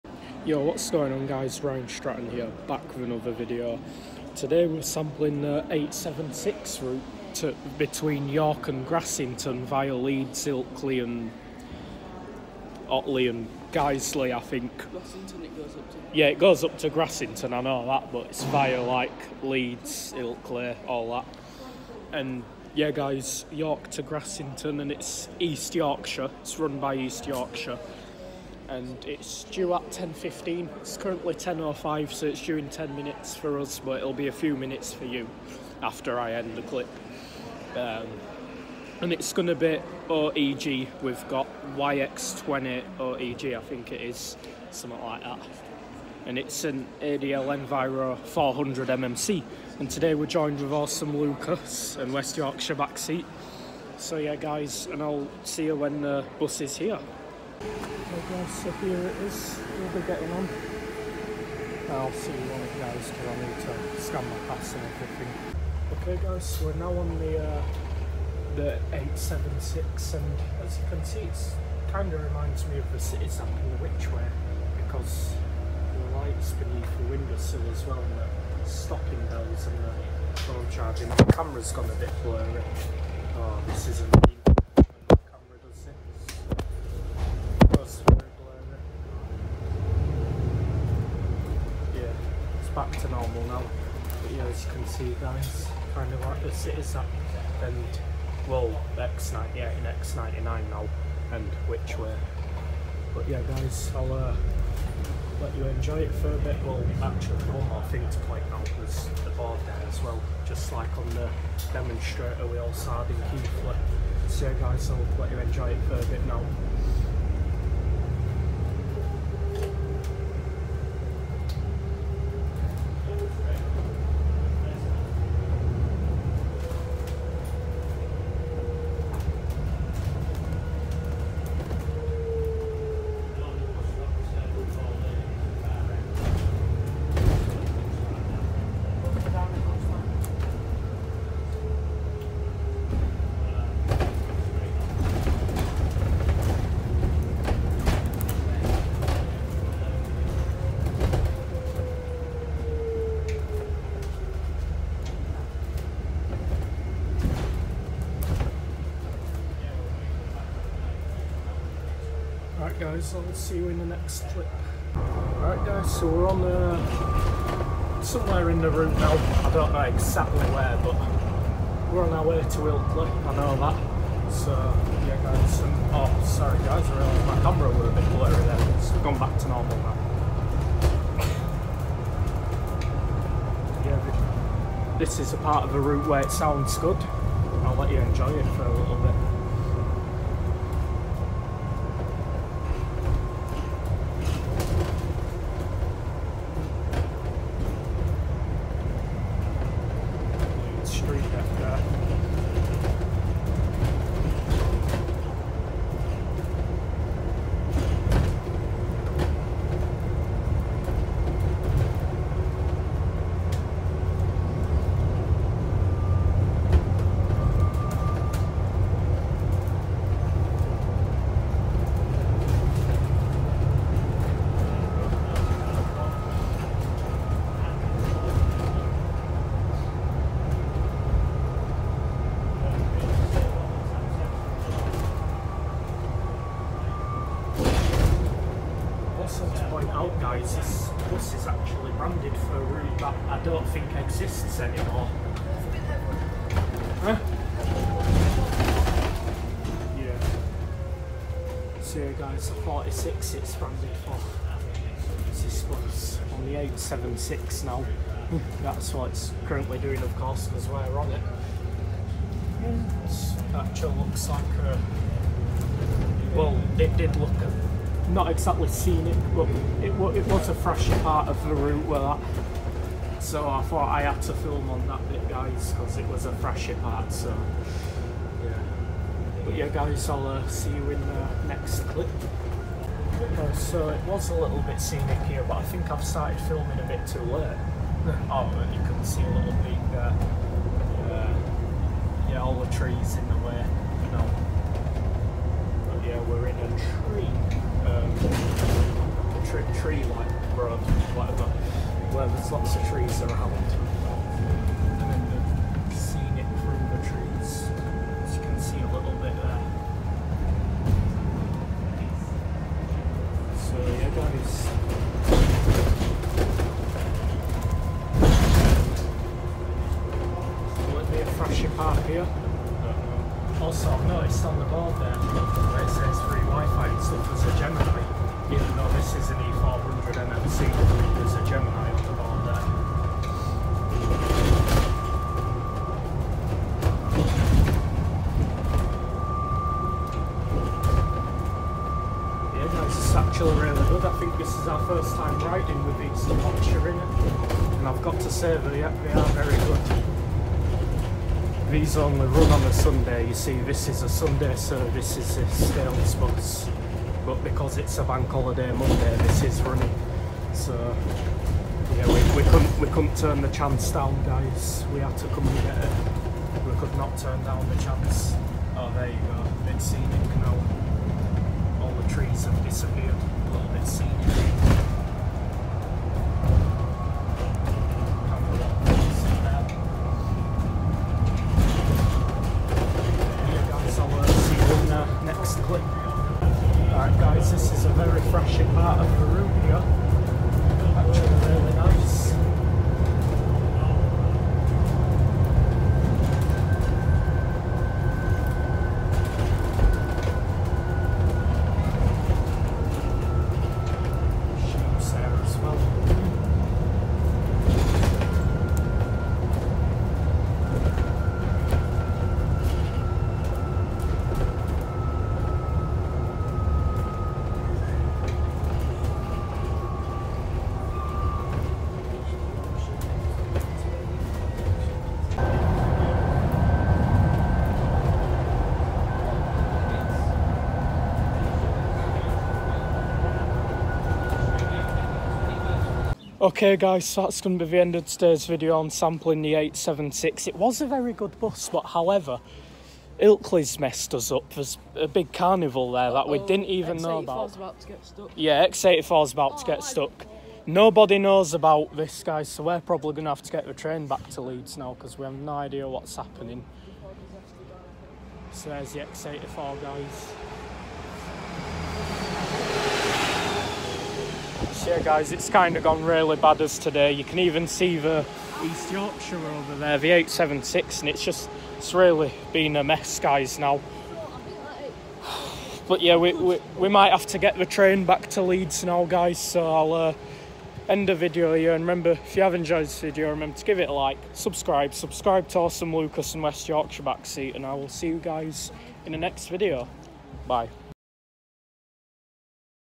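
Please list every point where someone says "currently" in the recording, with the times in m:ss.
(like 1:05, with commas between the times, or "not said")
0:30, 4:19.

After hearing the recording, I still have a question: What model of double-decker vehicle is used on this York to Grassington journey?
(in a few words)
ADL Enviro 400 MMC.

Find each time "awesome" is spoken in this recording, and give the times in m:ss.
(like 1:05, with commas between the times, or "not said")
0:50, 8:05.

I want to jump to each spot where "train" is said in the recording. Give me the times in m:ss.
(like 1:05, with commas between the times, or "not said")
7:33, 7:57.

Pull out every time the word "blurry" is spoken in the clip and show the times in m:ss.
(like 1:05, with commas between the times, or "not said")
1:22, 2:58.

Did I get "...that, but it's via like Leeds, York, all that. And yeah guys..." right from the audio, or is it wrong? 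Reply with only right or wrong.
wrong.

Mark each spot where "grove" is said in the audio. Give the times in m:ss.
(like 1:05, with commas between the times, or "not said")
5:00.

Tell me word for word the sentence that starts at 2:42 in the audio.
guys, I'll see you in the next clip.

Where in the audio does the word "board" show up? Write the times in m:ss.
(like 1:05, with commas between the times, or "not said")
1:49, 5:24.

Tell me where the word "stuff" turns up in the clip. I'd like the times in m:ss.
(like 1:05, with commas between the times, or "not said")
5:27.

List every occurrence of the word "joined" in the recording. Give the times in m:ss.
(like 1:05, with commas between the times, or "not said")
0:50.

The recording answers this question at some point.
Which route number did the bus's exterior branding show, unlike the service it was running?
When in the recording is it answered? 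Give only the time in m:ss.
4:12.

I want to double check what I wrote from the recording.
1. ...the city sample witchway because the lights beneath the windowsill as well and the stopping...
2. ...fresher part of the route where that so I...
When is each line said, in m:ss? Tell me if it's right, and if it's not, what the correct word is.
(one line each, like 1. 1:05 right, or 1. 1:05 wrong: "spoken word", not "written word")
1. 1:12 right
2. 4:30 right.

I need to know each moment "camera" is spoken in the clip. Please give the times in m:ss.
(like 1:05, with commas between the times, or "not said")
1:21, 2:57.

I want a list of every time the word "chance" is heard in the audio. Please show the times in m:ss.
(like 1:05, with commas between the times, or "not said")
6:03, 6:07.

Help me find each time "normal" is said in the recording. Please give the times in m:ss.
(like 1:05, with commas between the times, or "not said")
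1:33, 2:59.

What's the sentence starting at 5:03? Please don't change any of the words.
And then the scenic through the trees, as you can see a little bit there.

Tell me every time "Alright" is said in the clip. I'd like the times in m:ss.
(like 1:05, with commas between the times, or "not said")
2:44.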